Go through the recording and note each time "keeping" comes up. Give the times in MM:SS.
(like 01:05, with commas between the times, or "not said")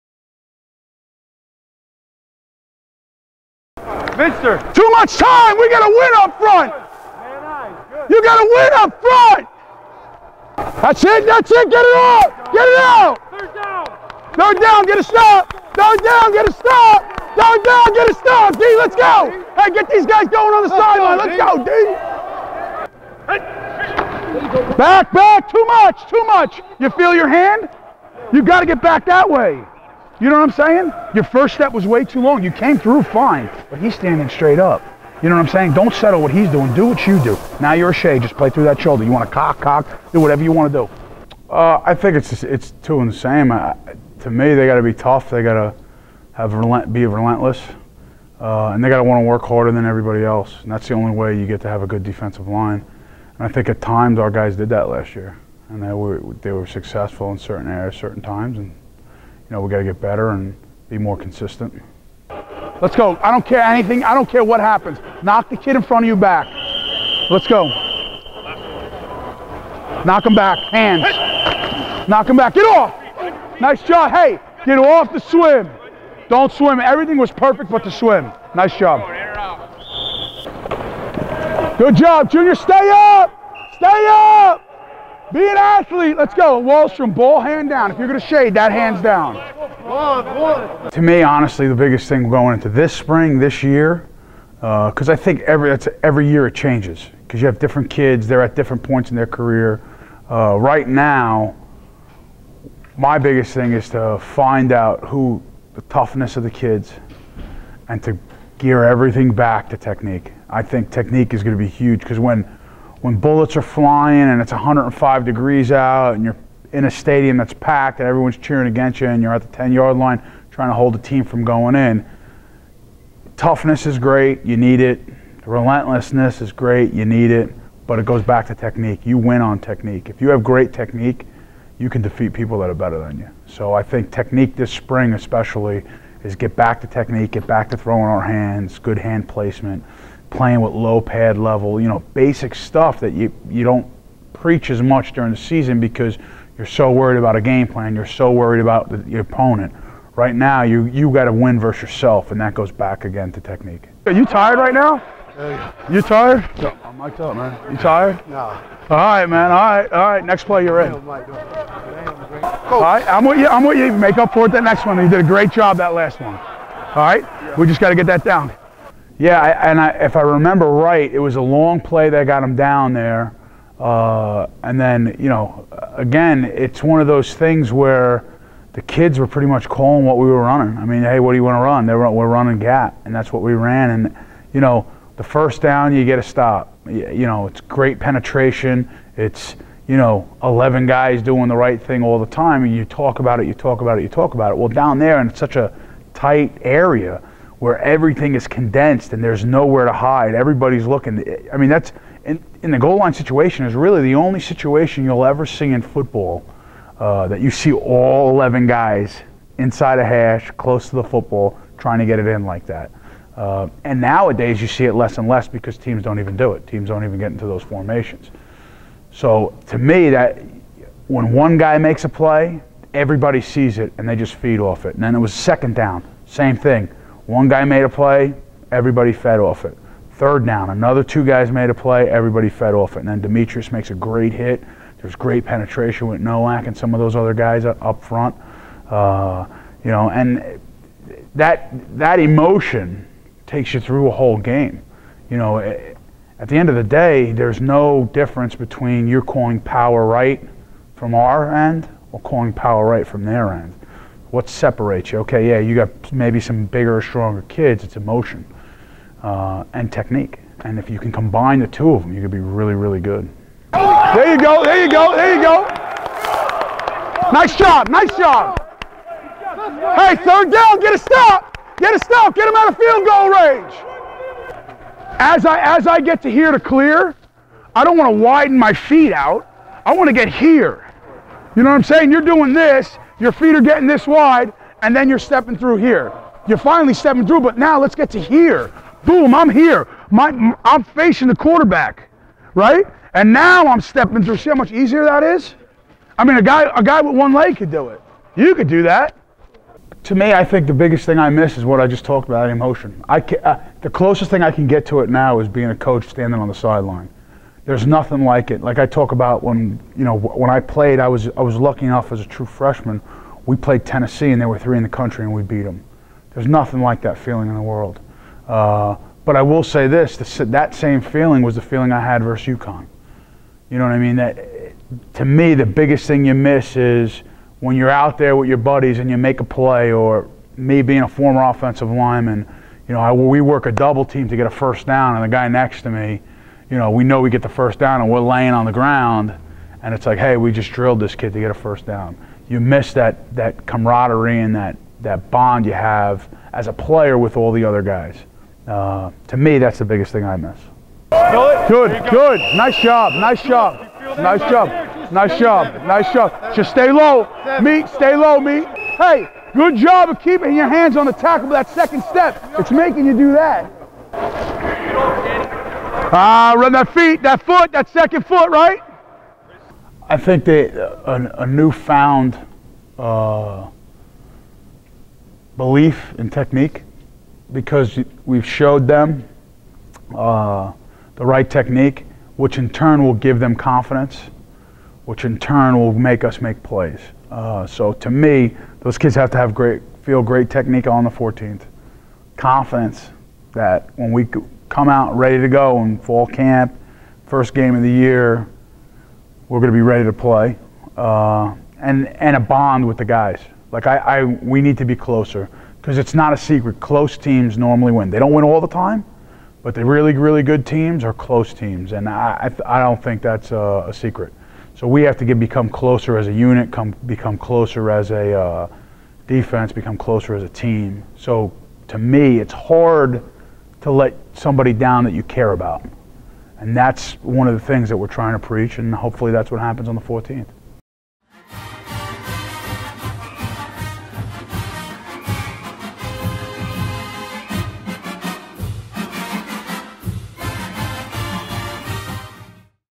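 06:00.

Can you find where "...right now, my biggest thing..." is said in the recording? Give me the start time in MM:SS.
01:40.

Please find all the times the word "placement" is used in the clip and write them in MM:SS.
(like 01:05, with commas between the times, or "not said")
02:19.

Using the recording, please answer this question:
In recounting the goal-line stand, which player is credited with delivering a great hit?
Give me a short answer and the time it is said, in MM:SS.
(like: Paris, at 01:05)
Demetrius, at 03:53.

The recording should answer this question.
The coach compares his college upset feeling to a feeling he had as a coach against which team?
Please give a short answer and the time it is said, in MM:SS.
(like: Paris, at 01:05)
UConn, at 05:22.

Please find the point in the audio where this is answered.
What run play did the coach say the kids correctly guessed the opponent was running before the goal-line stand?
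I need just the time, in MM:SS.
03:02.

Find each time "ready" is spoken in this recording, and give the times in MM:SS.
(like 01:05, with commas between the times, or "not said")
06:35, 06:39.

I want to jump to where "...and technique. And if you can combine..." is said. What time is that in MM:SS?
04:19.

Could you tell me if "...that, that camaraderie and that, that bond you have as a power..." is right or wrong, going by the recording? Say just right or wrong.
wrong.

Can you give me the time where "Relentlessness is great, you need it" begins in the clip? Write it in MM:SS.
02:05.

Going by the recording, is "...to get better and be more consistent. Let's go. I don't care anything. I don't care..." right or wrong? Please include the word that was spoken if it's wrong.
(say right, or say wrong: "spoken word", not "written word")
right.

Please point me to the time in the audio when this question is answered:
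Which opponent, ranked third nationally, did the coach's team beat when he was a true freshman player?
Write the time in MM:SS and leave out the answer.
05:13.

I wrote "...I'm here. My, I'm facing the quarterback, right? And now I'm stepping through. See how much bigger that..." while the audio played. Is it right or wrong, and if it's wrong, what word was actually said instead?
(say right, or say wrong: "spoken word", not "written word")
wrong: "easier", not "bigger".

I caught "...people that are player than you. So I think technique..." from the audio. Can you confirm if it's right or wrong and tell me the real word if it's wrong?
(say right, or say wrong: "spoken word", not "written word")
wrong: "better", not "player".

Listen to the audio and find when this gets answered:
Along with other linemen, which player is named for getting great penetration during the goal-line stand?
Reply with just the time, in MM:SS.
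03:56.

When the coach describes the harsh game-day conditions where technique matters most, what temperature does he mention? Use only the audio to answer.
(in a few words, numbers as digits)
105 degrees.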